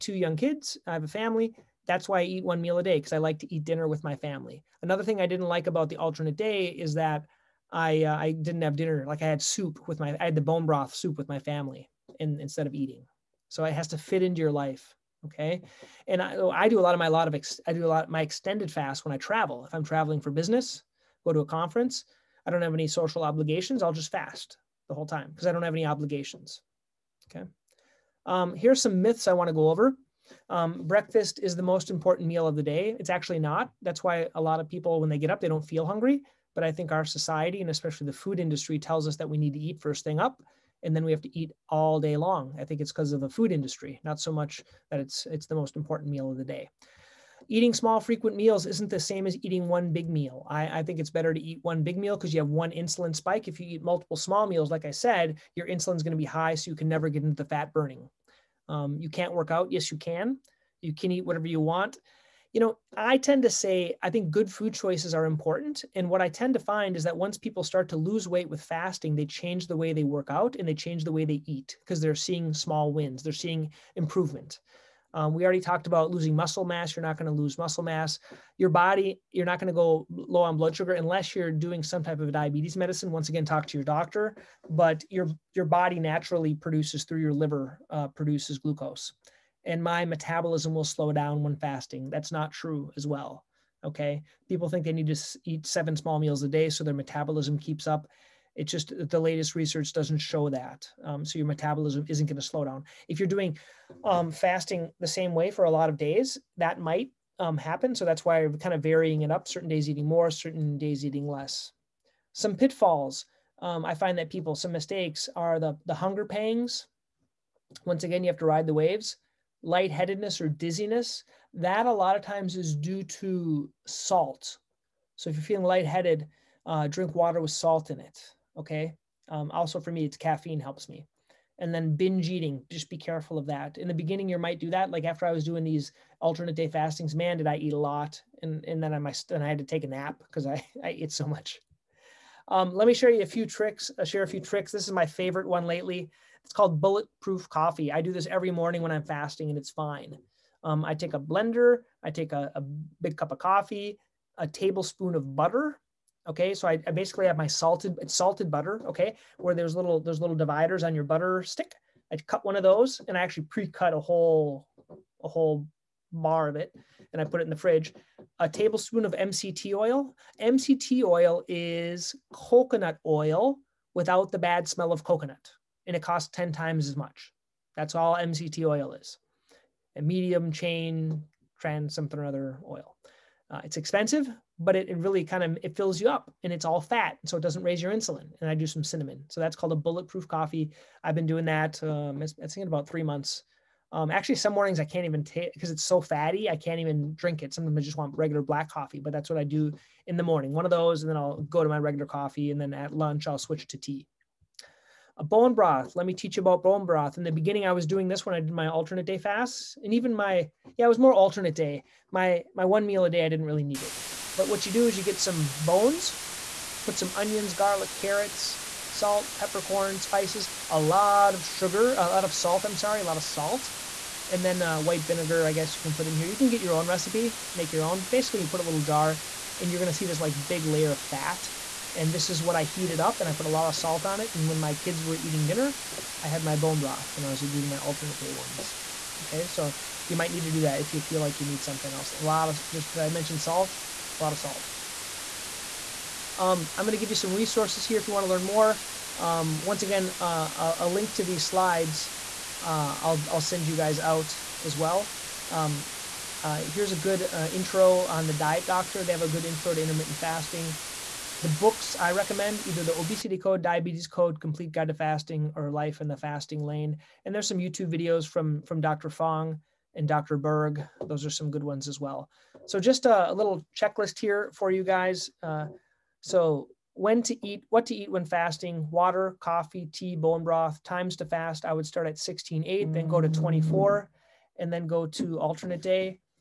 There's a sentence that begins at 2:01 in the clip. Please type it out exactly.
That a lot of times is due to salt.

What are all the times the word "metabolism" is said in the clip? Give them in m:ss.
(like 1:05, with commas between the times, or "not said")
1:30, 1:36, 1:41.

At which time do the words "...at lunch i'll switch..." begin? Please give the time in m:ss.
3:22.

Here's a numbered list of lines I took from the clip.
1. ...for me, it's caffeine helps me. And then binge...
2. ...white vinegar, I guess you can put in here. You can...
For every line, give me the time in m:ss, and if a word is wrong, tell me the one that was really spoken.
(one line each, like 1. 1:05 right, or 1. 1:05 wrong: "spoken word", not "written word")
1. 2:09 right
2. 3:44 right.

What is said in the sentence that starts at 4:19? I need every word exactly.
They have a good intro to intermittent fasting.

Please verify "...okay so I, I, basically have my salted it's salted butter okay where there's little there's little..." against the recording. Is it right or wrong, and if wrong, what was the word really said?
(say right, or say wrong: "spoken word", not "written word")
right.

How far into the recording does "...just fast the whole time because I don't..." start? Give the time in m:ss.
0:23.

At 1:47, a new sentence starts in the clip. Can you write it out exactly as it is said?
So that's why I'm kind of varying it up.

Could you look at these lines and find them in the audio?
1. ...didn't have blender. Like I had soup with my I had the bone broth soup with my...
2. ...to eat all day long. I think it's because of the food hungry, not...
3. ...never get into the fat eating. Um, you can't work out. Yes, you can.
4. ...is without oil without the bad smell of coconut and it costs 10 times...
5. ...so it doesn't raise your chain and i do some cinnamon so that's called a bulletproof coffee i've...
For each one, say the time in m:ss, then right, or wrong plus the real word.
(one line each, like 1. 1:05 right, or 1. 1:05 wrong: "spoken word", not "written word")
1. 0:08 wrong: "dinner", not "blender"
2. 0:41 wrong: "industry", not "hungry"
3. 0:56 wrong: "burning", not "eating"
4. 2:51 wrong: "coconut", not "without"
5. 3:07 wrong: "insulin", not "chain".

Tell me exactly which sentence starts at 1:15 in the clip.
Um, we already talked about losing muscle mass.